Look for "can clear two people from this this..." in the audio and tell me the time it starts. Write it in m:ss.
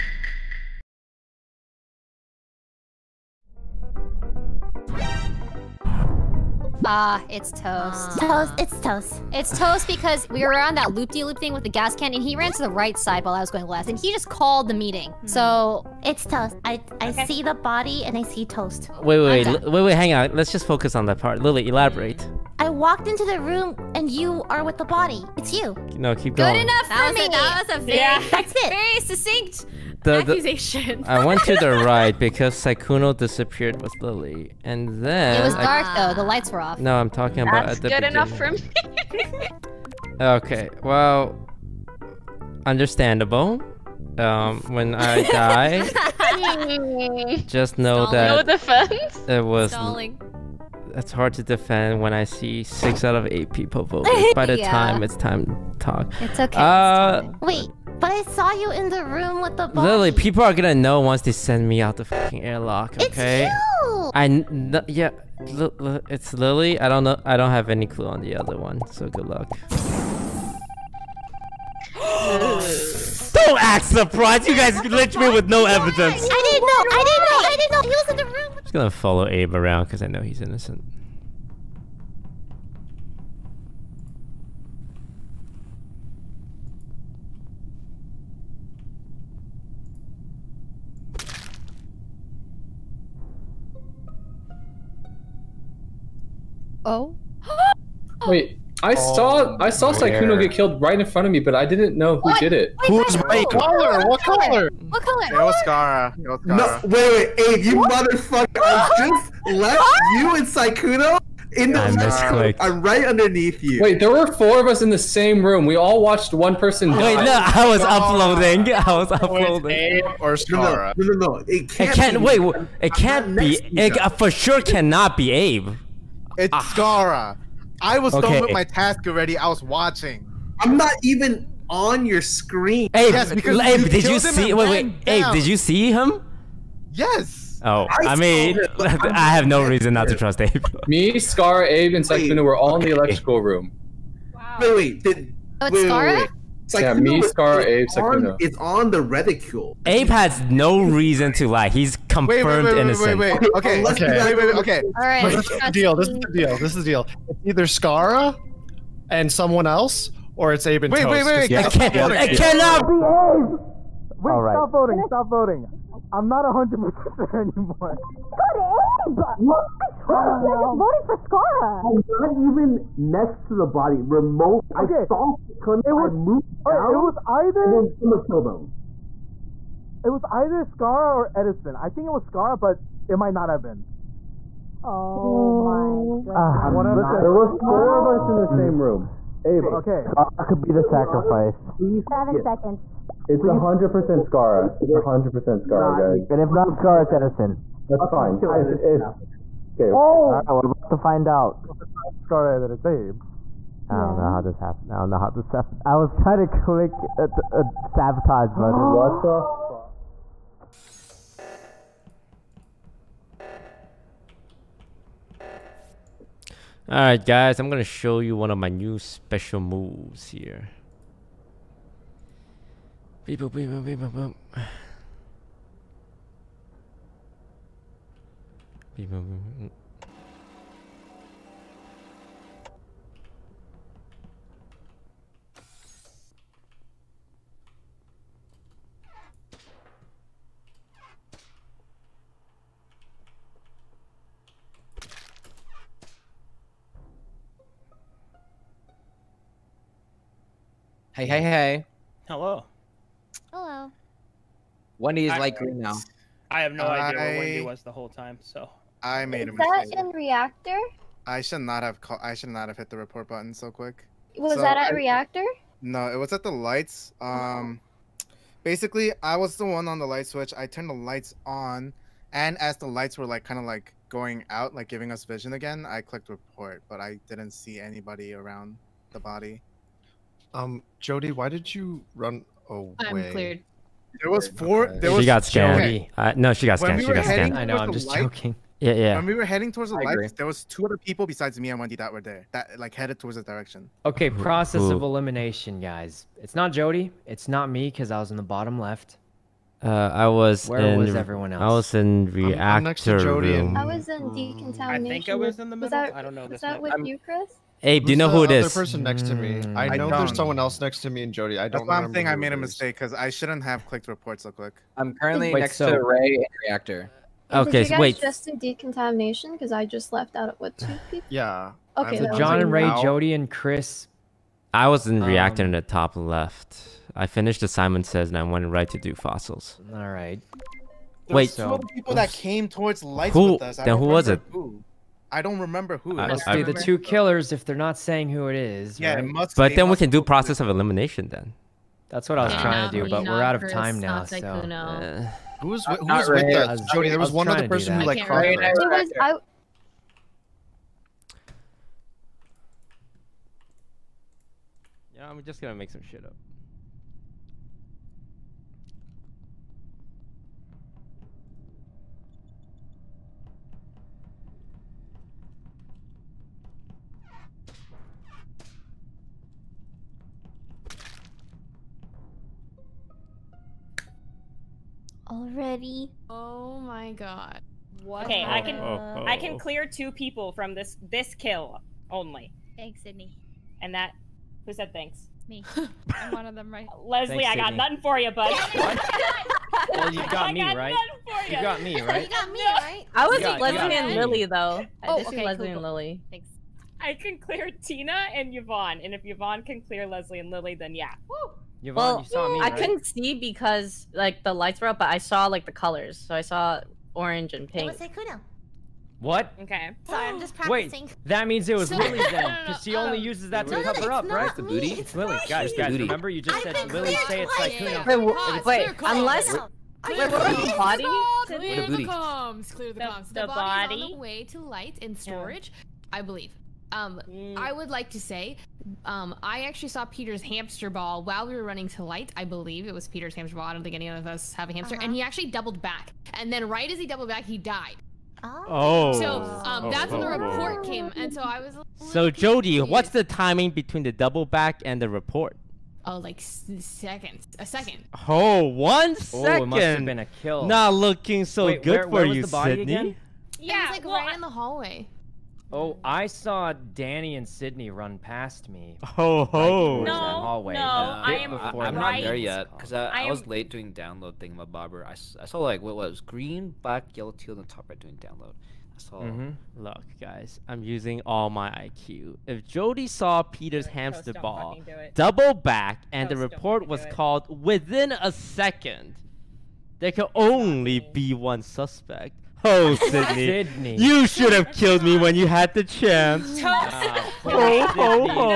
6:19.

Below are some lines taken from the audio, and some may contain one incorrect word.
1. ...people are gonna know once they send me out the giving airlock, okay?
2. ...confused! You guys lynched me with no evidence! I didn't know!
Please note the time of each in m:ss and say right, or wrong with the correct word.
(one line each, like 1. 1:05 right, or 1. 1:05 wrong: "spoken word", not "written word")
1. 1:00 wrong: "fucking", not "giving"
2. 1:13 wrong: "surprised", not "confused".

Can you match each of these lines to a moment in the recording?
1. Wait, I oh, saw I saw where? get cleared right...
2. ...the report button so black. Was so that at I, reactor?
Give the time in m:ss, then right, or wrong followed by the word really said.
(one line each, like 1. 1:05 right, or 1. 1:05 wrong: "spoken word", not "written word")
1. 1:38 wrong: "killed", not "cleared"
2. 4:22 wrong: "quick", not "black".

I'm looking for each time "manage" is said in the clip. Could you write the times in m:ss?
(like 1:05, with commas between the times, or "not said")
not said.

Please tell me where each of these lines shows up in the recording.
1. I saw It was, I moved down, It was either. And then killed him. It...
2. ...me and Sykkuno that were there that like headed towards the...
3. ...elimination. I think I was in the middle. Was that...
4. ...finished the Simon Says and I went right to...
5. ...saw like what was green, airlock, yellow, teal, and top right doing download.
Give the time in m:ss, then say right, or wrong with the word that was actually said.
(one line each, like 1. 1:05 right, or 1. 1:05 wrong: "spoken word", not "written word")
1. 2:55 right
2. 4:51 wrong: "Wendy", not "Sykkuno"
3. 5:04 wrong: "decontamination", not "elimination"
4. 5:27 right
5. 7:45 wrong: "black", not "airlock".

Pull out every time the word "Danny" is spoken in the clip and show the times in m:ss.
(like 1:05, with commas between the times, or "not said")
7:36.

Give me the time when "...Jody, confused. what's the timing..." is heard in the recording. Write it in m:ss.
7:22.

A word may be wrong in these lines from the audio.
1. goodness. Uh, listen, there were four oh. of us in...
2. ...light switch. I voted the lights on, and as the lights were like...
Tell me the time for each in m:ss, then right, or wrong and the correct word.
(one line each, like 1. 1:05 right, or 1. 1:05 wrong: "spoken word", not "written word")
1. 3:06 right
2. 4:30 wrong: "turned", not "voted".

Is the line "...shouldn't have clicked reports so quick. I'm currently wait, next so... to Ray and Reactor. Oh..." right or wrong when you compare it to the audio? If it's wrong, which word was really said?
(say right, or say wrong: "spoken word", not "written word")
right.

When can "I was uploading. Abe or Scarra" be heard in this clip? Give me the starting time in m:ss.
1:58.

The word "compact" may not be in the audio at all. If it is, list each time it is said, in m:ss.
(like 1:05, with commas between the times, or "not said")
not said.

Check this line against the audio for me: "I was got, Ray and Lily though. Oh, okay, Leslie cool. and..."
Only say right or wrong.
wrong.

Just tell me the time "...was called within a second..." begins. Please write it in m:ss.
7:56.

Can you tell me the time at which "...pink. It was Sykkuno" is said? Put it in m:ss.
6:47.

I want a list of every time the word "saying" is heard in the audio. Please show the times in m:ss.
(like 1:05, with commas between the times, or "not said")
5:12, 5:37.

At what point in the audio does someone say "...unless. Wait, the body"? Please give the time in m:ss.
6:59.